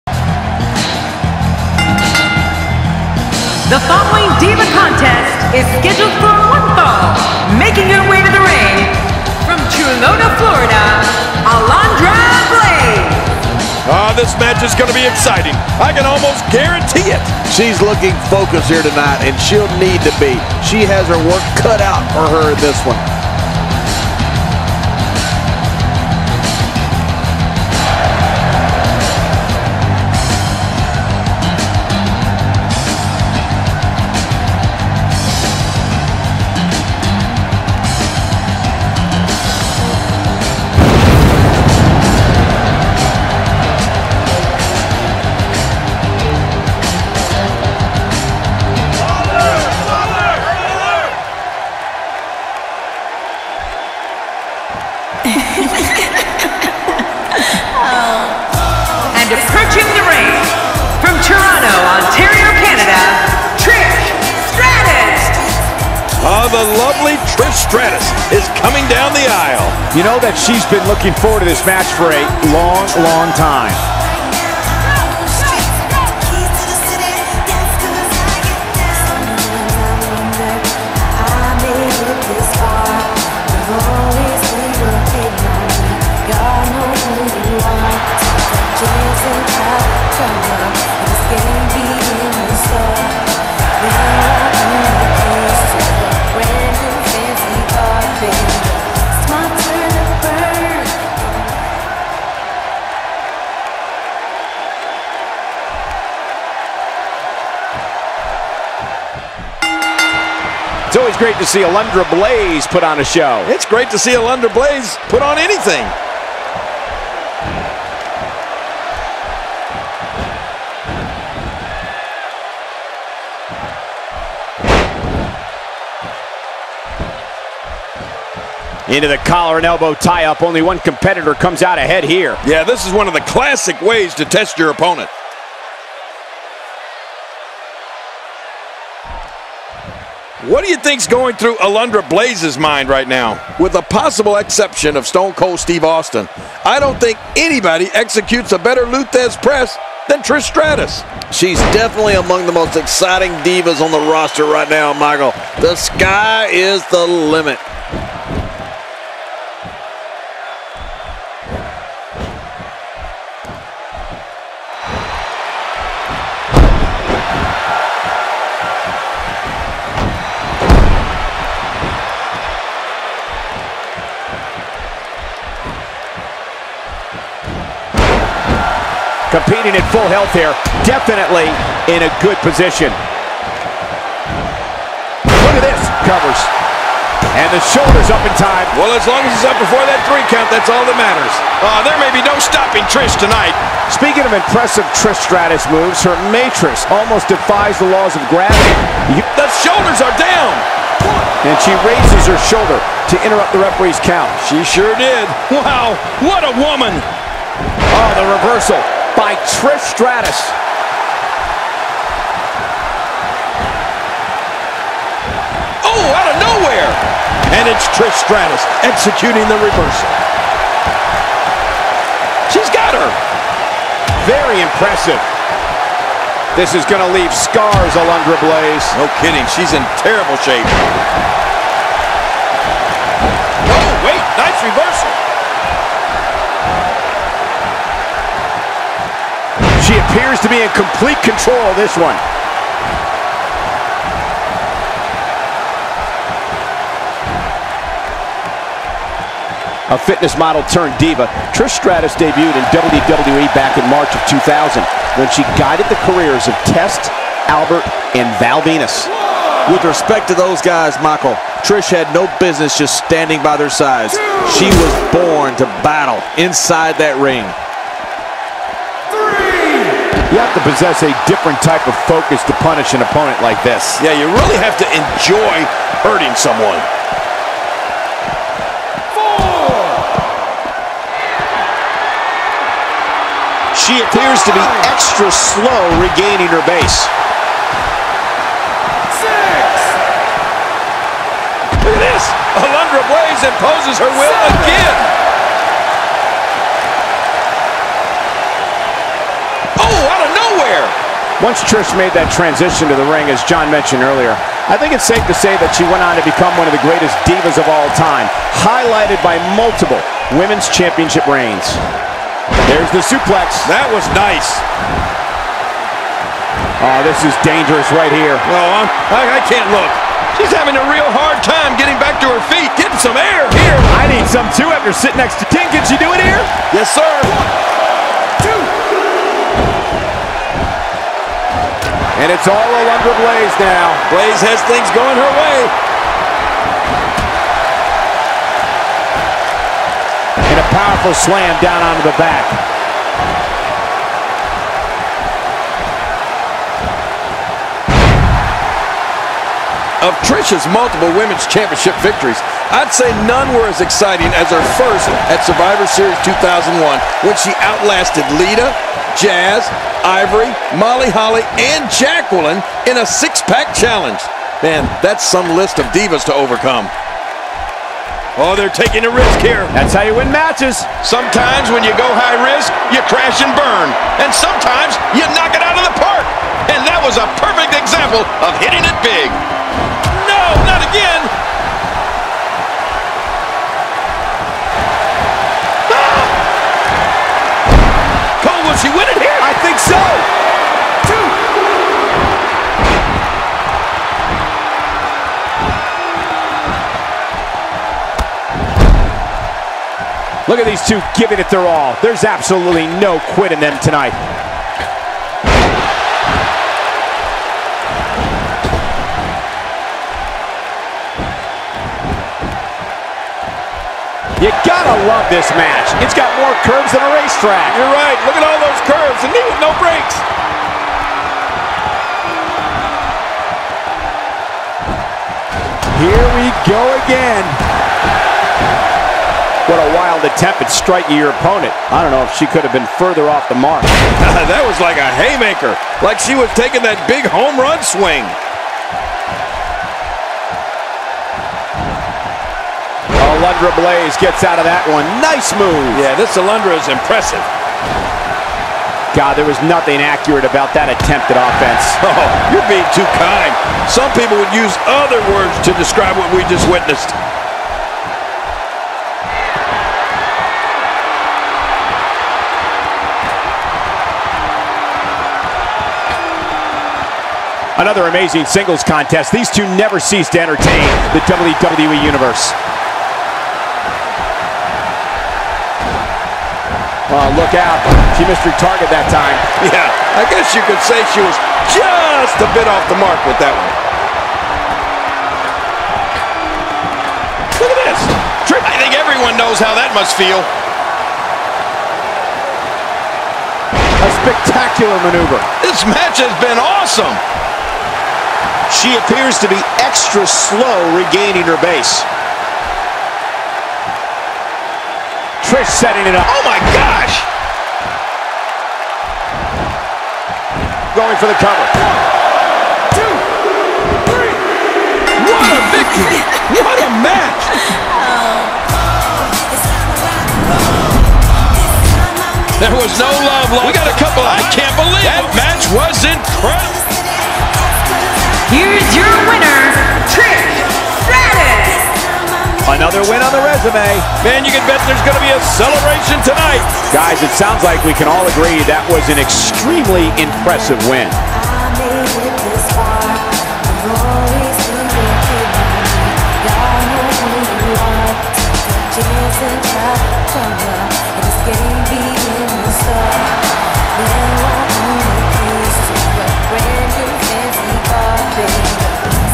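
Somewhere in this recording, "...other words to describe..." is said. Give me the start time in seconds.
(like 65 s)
454 s.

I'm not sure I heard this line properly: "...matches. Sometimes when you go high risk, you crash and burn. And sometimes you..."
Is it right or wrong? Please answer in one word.
right.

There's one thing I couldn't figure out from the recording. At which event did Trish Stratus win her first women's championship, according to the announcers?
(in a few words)
Survivor Series 2001.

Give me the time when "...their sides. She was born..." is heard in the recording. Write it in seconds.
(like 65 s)
263 s.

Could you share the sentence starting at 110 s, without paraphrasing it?
It's always great to see Alundra Blayze put on a show.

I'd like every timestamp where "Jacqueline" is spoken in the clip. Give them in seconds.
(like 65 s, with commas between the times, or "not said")
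361 s.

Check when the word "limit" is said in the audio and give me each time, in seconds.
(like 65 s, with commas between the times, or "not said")
157 s.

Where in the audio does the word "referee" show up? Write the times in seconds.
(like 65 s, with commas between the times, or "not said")
203 s.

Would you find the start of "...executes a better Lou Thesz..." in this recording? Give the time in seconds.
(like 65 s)
147 s.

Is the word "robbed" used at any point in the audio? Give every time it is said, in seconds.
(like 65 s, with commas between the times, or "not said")
not said.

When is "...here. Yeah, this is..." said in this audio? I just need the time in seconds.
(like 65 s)
132 s.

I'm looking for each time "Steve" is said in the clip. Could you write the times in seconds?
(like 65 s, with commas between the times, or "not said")
145 s.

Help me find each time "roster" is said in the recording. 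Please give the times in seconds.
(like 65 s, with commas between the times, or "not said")
153 s.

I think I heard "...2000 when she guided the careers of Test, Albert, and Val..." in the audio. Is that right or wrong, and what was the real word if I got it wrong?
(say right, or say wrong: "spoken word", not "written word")
right.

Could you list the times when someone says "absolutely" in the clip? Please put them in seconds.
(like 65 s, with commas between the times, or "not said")
402 s.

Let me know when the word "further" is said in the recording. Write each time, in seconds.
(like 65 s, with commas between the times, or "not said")
432 s.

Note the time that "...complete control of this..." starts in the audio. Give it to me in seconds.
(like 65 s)
240 s.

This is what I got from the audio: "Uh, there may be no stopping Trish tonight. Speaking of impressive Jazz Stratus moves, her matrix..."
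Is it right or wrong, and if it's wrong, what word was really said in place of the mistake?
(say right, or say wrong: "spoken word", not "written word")
wrong: "Trish", not "Jazz".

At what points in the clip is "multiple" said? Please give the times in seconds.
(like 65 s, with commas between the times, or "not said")
309 s, 350 s.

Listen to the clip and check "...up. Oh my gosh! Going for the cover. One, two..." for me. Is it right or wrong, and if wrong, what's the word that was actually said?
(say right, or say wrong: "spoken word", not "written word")
right.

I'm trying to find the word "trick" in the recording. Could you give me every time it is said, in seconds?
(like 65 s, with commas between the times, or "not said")
not said.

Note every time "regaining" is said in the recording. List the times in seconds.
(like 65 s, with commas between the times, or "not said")
285 s, 500 s.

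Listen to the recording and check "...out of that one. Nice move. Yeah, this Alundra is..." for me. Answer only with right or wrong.
right.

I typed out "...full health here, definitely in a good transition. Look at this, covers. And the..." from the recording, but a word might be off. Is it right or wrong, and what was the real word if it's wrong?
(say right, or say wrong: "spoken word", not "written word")
wrong: "position", not "transition".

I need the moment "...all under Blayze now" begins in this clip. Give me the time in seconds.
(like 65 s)
332 s.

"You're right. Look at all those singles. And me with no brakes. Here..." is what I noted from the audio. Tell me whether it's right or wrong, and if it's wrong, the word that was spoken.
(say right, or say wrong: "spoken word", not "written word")
wrong: "curves", not "singles".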